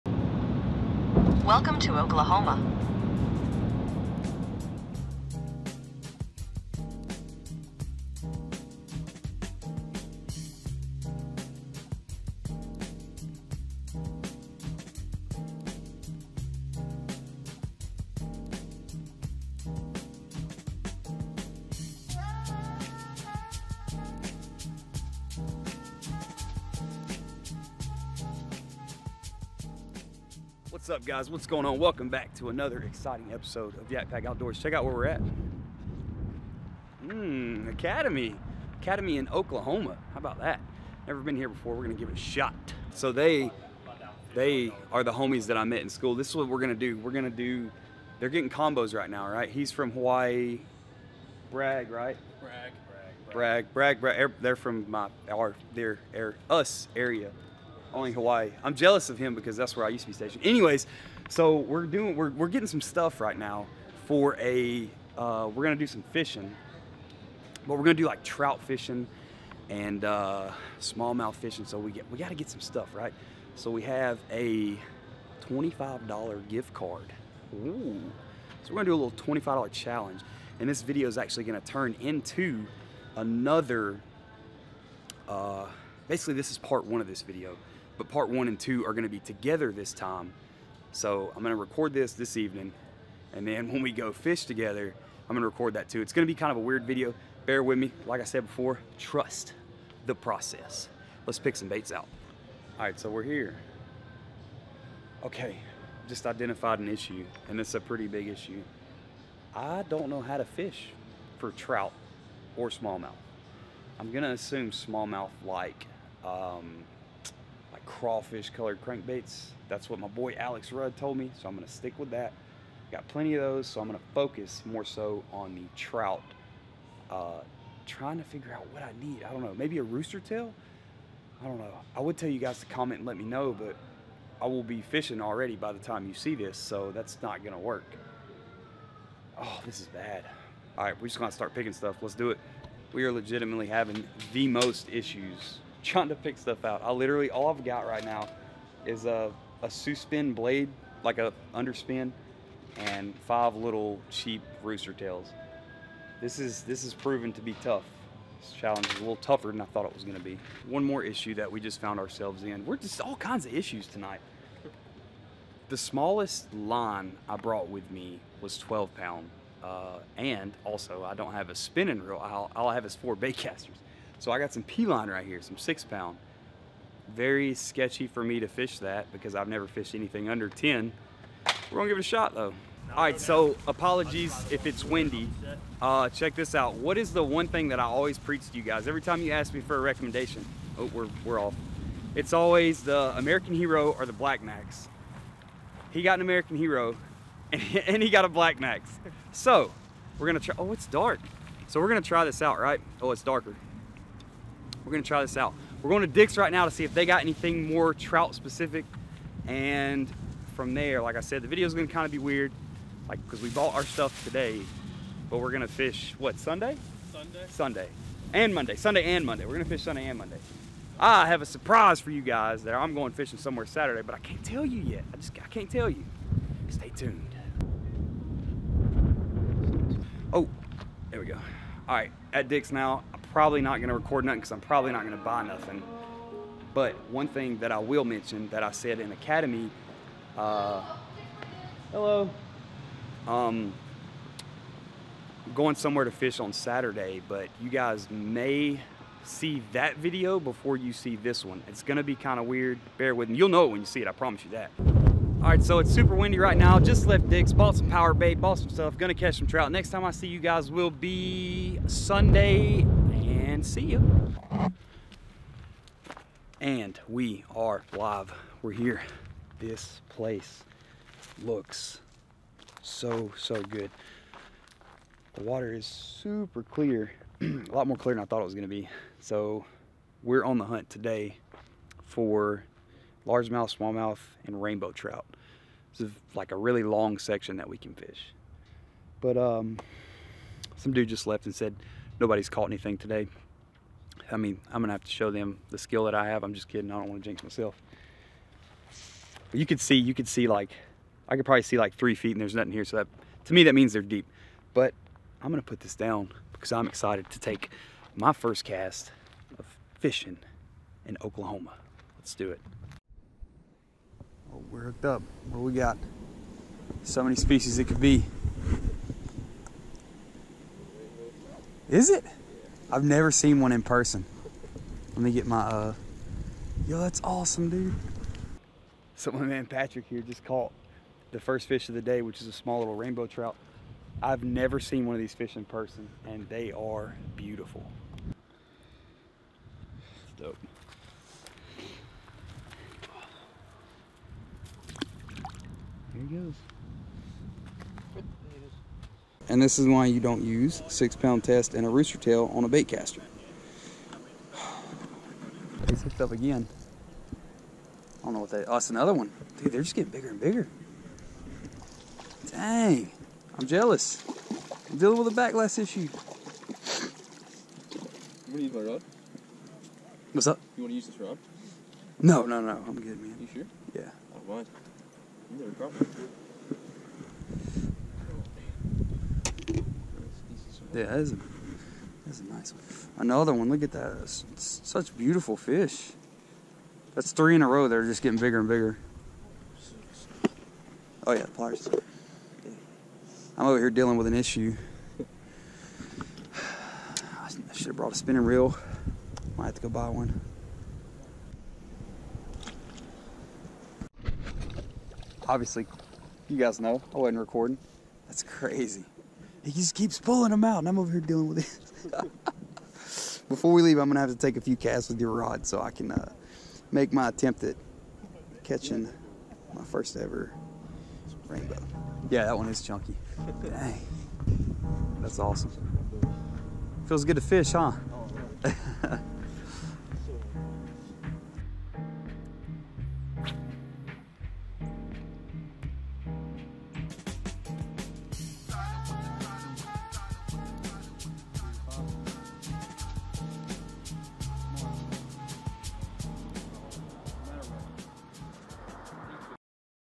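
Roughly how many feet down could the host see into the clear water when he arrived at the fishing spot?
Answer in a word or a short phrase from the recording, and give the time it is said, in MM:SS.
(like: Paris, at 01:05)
3, at 05:01.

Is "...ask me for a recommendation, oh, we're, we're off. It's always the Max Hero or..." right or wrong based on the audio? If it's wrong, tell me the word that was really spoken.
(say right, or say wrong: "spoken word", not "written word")
wrong: "American", not "Max".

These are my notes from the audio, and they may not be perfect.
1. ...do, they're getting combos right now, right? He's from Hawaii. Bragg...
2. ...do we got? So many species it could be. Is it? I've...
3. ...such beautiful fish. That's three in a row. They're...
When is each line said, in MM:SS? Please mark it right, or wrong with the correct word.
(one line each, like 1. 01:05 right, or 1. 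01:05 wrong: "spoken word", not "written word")
1. 00:47 right
2. 05:15 right
3. 06:24 right.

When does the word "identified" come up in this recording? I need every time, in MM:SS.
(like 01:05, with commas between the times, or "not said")
01:46.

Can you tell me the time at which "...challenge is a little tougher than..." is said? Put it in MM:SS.
02:38.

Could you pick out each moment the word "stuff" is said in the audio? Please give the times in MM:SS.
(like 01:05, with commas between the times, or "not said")
01:02, 01:12, 02:21, 02:26, 03:33, 04:18.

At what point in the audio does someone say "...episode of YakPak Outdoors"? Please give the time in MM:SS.
00:33.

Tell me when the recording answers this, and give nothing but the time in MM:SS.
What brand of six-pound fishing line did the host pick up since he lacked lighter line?
02:54.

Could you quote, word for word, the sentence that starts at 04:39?
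So we're on the hunt today for largemouth, smallmouth, and rainbow trout.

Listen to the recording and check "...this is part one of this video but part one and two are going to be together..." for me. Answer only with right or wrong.
right.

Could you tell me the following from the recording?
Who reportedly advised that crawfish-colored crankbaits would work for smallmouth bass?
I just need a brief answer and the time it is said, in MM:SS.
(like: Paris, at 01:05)
Alex Rudd, at 02:00.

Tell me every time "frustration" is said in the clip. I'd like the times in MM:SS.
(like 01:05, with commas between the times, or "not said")
not said.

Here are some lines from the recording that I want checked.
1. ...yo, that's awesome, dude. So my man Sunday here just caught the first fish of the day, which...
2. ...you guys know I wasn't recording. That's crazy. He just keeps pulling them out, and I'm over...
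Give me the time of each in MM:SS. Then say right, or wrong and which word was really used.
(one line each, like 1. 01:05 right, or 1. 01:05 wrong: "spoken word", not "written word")
1. 05:26 wrong: "Patrick", not "Sunday"
2. 06:46 right.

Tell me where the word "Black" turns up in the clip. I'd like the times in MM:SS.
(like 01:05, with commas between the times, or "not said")
03:14, 03:18.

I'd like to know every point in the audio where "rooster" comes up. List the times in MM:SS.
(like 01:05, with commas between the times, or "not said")
02:09, 02:34, 05:51.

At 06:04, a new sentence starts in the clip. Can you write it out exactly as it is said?
I'm dealing with a backlash issue.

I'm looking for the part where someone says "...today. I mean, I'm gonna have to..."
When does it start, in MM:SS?
04:52.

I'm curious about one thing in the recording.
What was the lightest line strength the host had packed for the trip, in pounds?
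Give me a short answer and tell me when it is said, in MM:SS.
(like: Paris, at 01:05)
12, at 02:48.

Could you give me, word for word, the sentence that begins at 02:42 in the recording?
We're just all kinds of issues tonight.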